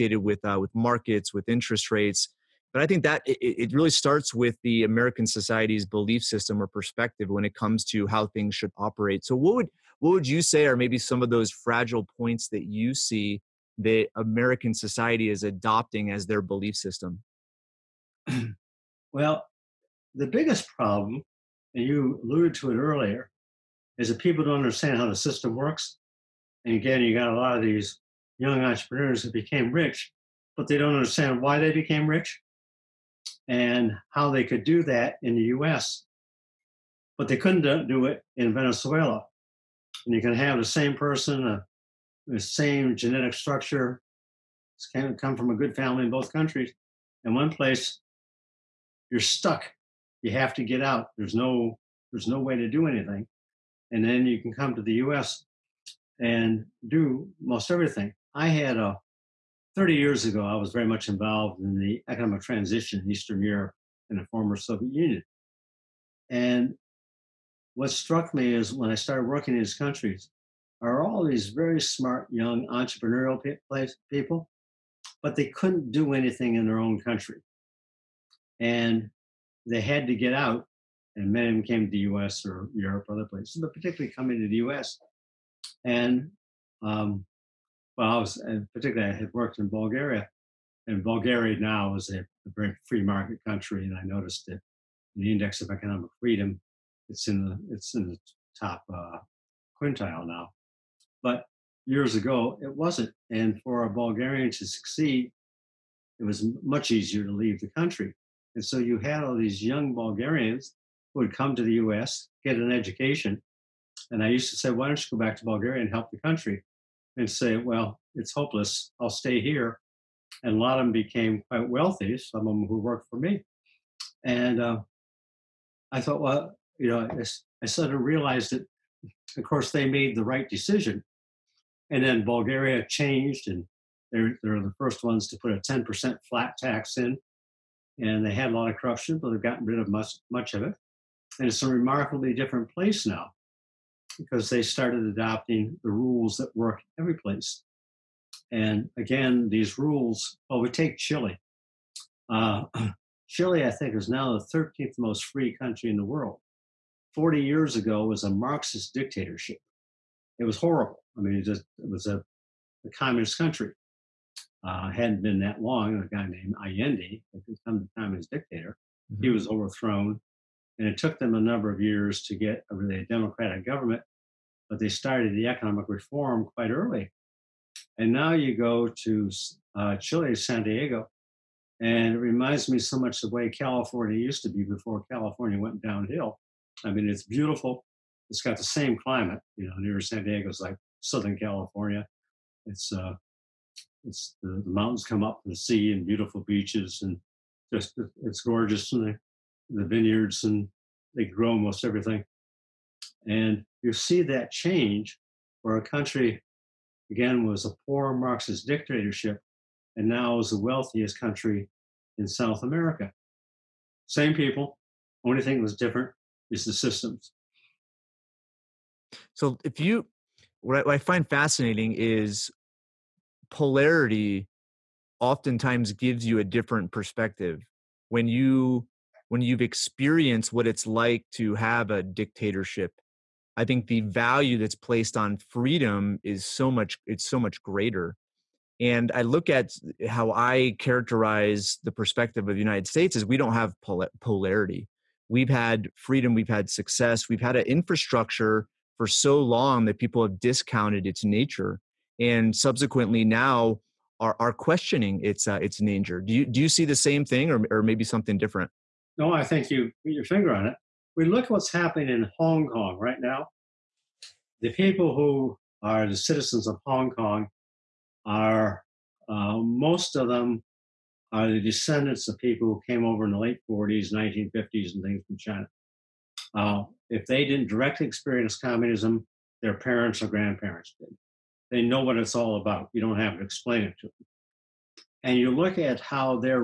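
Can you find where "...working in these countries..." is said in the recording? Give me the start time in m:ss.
1:09.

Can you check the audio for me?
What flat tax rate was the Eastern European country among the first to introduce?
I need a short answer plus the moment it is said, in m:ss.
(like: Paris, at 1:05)
10%, at 2:15.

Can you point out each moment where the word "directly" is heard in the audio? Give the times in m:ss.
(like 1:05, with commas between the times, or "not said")
4:37.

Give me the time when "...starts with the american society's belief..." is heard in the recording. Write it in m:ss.
0:03.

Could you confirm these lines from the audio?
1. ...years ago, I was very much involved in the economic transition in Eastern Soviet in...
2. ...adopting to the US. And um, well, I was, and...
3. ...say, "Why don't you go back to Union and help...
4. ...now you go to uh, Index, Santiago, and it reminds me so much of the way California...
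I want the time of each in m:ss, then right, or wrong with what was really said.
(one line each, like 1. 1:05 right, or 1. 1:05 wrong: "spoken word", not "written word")
1. 0:59 wrong: "Europe", not "Soviet"
2. 1:24 wrong: "coming", not "adopting"
3. 1:54 wrong: "Bulgaria", not "Union"
4. 2:58 wrong: "Chile", not "Index".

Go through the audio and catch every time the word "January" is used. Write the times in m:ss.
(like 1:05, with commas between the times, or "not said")
not said.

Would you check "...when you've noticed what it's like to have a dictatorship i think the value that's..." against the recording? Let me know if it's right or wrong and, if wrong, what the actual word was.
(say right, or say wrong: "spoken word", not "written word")
wrong: "experienced", not "noticed".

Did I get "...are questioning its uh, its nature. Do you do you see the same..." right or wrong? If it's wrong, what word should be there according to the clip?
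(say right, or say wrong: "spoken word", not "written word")
right.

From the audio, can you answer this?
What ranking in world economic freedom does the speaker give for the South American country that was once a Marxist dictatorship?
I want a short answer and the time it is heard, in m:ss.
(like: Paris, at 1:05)
13th, at 2:34.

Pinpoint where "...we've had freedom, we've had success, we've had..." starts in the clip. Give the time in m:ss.
4:05.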